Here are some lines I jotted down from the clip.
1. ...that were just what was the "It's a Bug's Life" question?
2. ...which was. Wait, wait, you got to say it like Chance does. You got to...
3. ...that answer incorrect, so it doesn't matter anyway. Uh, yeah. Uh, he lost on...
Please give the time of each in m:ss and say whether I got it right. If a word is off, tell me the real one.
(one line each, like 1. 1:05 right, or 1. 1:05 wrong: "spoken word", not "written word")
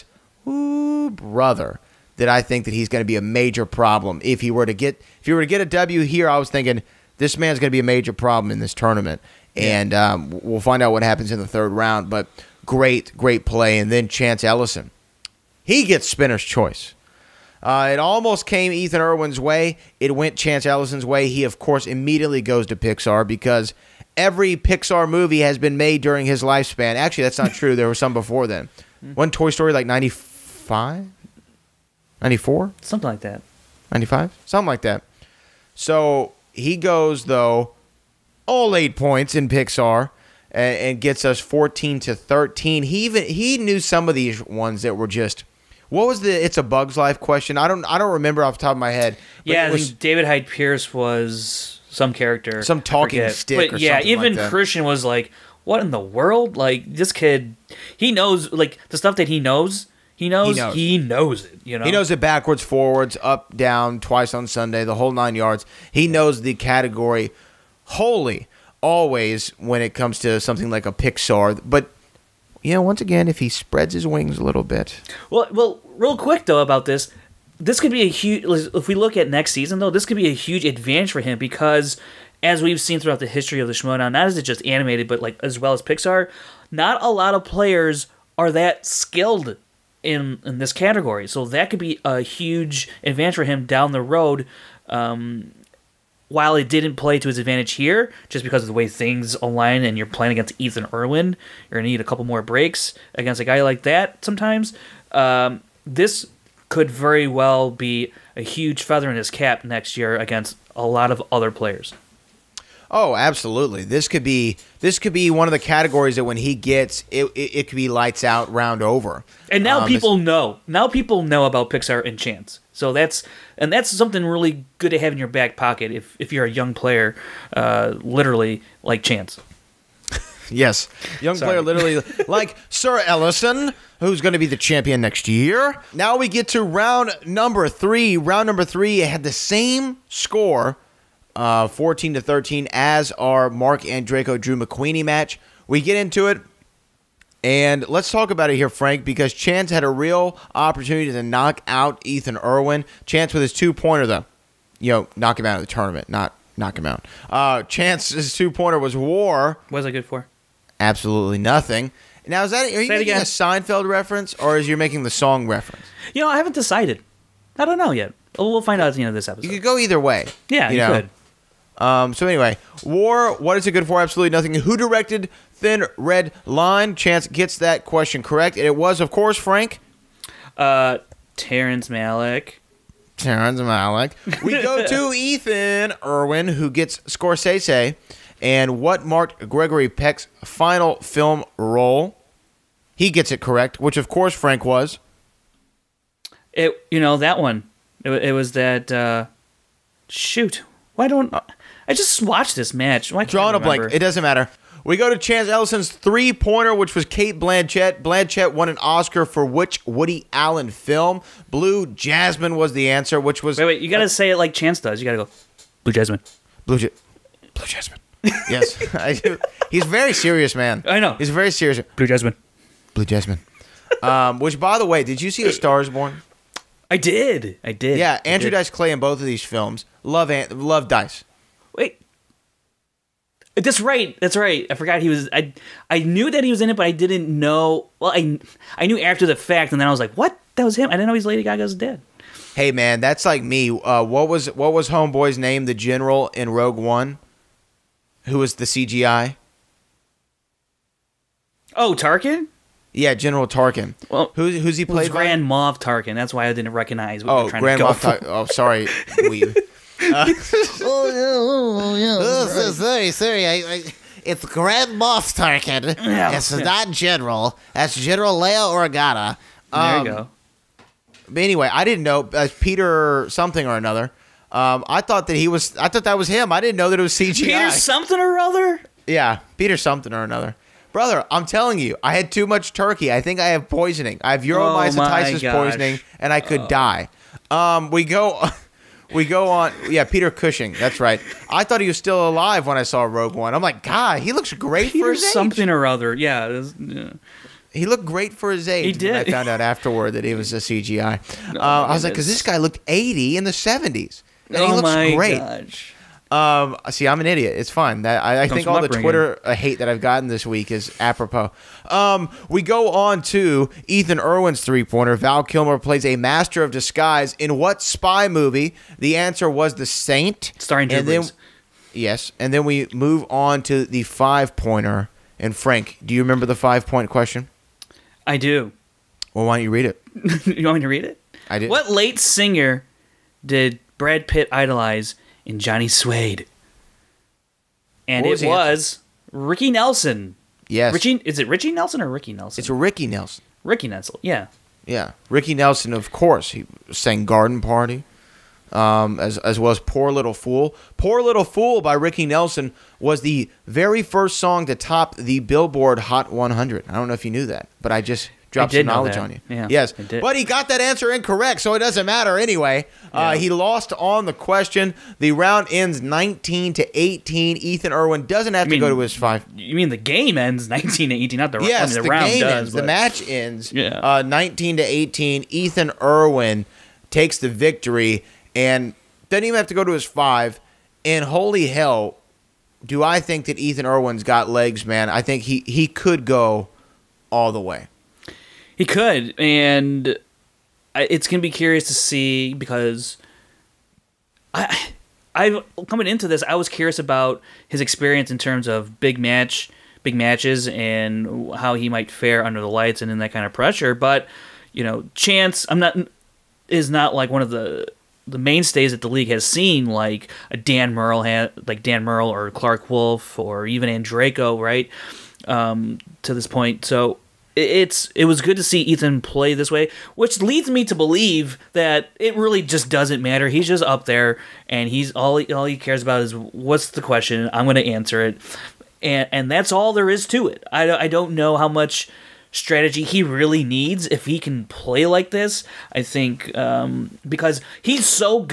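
1. 0:44 right
2. 3:33 right
3. 6:00 right.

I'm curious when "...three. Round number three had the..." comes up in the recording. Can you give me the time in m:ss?
2:17.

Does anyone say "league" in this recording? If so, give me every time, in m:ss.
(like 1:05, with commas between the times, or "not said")
6:49.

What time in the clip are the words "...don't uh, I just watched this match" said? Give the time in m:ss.
3:21.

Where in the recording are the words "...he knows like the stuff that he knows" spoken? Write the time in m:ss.
0:57.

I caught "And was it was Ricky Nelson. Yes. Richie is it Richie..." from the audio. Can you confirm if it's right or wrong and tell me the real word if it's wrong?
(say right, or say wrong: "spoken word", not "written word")
right.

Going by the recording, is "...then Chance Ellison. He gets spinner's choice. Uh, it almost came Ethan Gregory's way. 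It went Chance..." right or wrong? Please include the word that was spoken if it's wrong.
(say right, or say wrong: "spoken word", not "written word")
wrong: "Irwin", not "Gregory".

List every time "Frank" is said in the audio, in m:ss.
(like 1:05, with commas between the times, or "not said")
2:28, 2:59, 3:14, 5:25.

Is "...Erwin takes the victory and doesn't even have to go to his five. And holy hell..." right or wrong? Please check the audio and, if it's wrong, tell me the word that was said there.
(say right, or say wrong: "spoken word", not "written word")
right.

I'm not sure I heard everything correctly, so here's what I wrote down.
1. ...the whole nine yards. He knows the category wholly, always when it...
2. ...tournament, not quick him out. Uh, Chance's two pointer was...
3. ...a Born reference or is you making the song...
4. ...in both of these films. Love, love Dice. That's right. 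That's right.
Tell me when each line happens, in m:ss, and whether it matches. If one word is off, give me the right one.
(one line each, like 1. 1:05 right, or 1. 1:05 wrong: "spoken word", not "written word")
1. 1:04 right
2. 2:35 wrong: "knock", not "quick"
3. 2:43 wrong: "Seinfeld", not "Born"
4. 3:48 right.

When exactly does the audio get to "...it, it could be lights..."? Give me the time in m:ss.
1:57.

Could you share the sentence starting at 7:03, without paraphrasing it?
He's just up there, and he's all he, all he cares about is what's the question.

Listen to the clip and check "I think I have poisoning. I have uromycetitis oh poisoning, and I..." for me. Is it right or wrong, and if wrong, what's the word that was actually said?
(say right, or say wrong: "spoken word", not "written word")
right.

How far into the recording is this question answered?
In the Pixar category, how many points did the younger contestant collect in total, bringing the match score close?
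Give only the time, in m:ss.
0:38.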